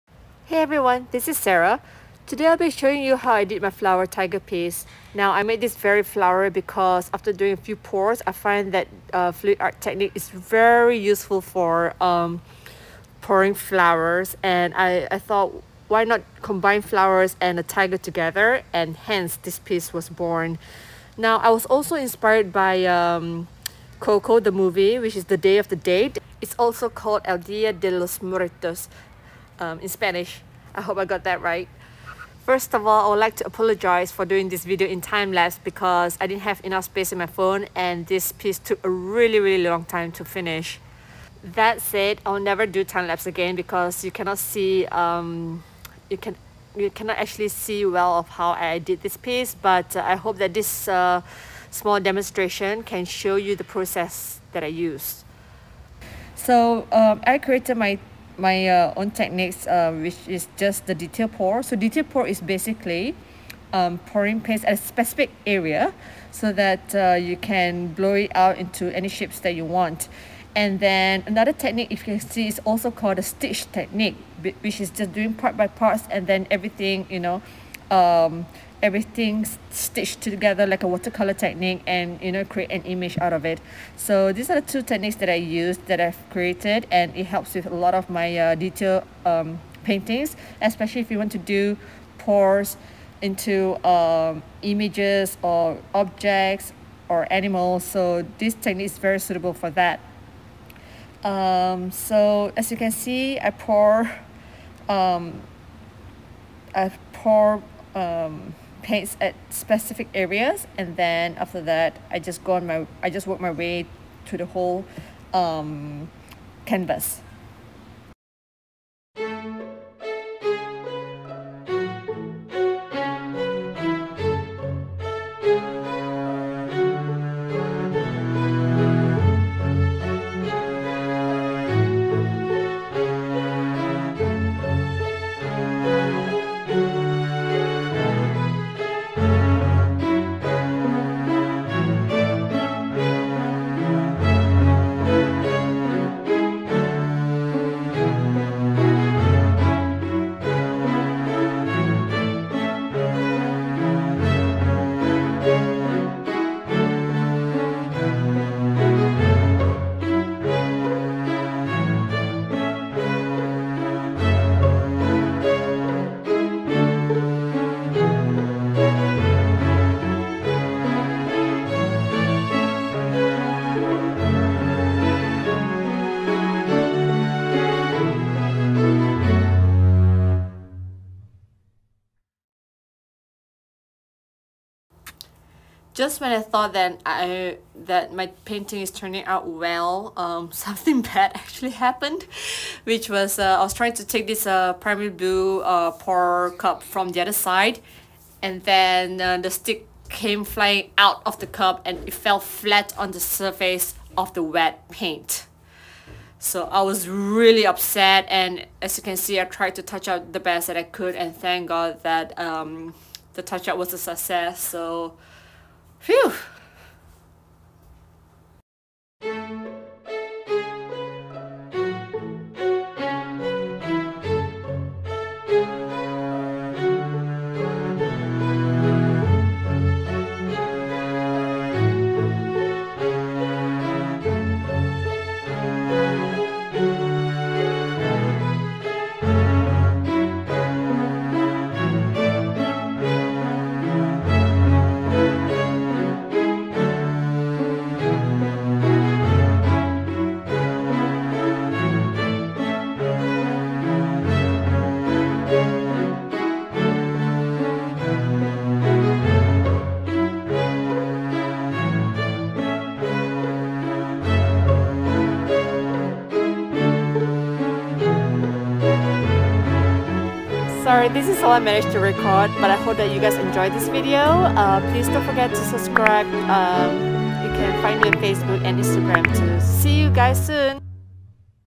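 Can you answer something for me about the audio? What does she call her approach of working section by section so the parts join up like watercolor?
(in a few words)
stitch technique.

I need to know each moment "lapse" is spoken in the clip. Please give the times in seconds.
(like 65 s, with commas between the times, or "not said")
35 s, 43 s.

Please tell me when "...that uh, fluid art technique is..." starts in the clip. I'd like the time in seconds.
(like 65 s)
8 s.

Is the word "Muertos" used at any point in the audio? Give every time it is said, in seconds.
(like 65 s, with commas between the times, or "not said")
28 s.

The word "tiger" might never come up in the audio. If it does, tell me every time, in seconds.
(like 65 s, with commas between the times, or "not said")
4 s, 17 s.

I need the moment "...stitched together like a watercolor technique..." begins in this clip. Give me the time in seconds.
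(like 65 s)
79 s.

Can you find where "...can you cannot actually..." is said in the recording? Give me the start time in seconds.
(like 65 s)
46 s.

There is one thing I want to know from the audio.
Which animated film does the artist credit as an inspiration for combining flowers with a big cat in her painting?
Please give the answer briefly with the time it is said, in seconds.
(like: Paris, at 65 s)
Coco, at 24 s.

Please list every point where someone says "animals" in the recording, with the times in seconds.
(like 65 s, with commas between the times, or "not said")
97 s.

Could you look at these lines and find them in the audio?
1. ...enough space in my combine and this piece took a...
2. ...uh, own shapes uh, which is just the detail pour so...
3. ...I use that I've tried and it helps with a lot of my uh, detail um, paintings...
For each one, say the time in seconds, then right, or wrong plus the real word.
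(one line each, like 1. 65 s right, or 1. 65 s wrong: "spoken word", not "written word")
1. 36 s wrong: "phone", not "combine"
2. 58 s wrong: "techniques", not "shapes"
3. 85 s wrong: "created", not "tried".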